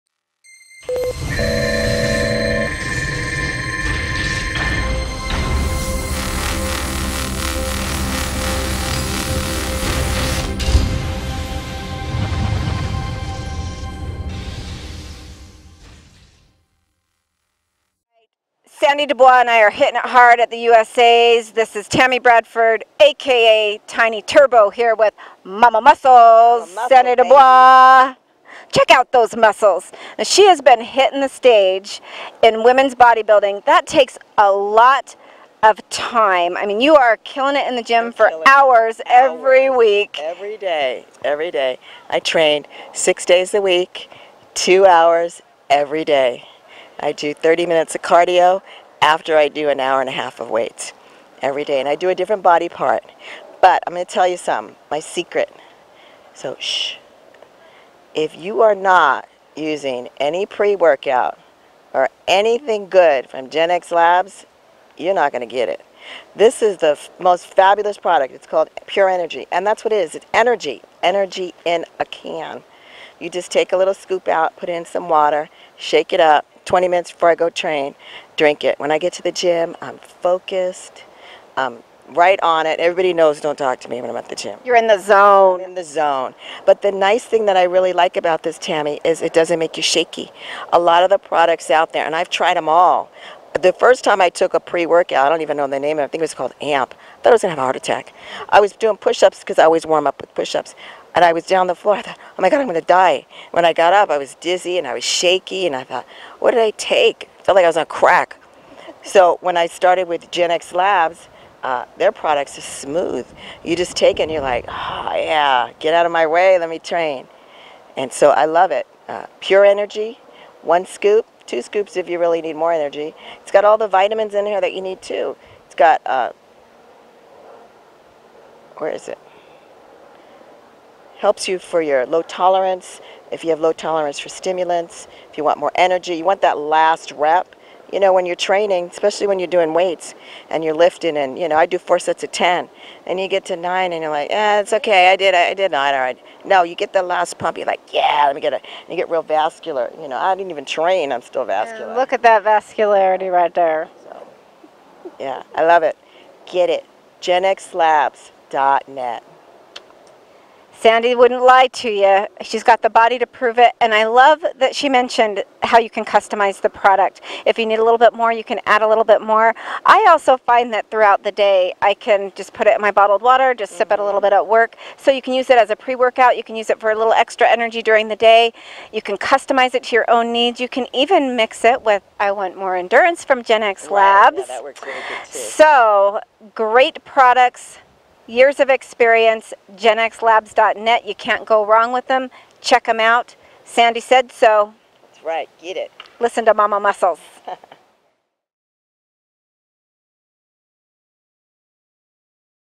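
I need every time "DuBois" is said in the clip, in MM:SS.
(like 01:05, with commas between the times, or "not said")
00:19, 00:27.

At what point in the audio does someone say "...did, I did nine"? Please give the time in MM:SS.
02:25.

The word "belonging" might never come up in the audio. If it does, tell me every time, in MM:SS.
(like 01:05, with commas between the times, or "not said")
not said.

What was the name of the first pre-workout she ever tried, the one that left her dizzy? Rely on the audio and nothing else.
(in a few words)
AMP.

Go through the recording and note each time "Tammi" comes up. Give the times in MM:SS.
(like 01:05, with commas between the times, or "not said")
00:21, 01:28.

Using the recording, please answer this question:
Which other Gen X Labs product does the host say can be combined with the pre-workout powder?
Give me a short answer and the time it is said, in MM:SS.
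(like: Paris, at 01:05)
I Want More Endurance, at 03:02.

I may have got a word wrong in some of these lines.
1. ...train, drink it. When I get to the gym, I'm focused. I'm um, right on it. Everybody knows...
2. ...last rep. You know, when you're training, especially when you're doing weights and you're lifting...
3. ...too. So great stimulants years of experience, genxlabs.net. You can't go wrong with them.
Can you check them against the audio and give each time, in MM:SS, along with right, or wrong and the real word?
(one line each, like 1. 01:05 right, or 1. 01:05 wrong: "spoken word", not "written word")
1. 01:17 right
2. 02:16 right
3. 03:05 wrong: "products", not "stimulants".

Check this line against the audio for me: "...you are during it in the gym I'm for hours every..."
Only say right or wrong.
wrong.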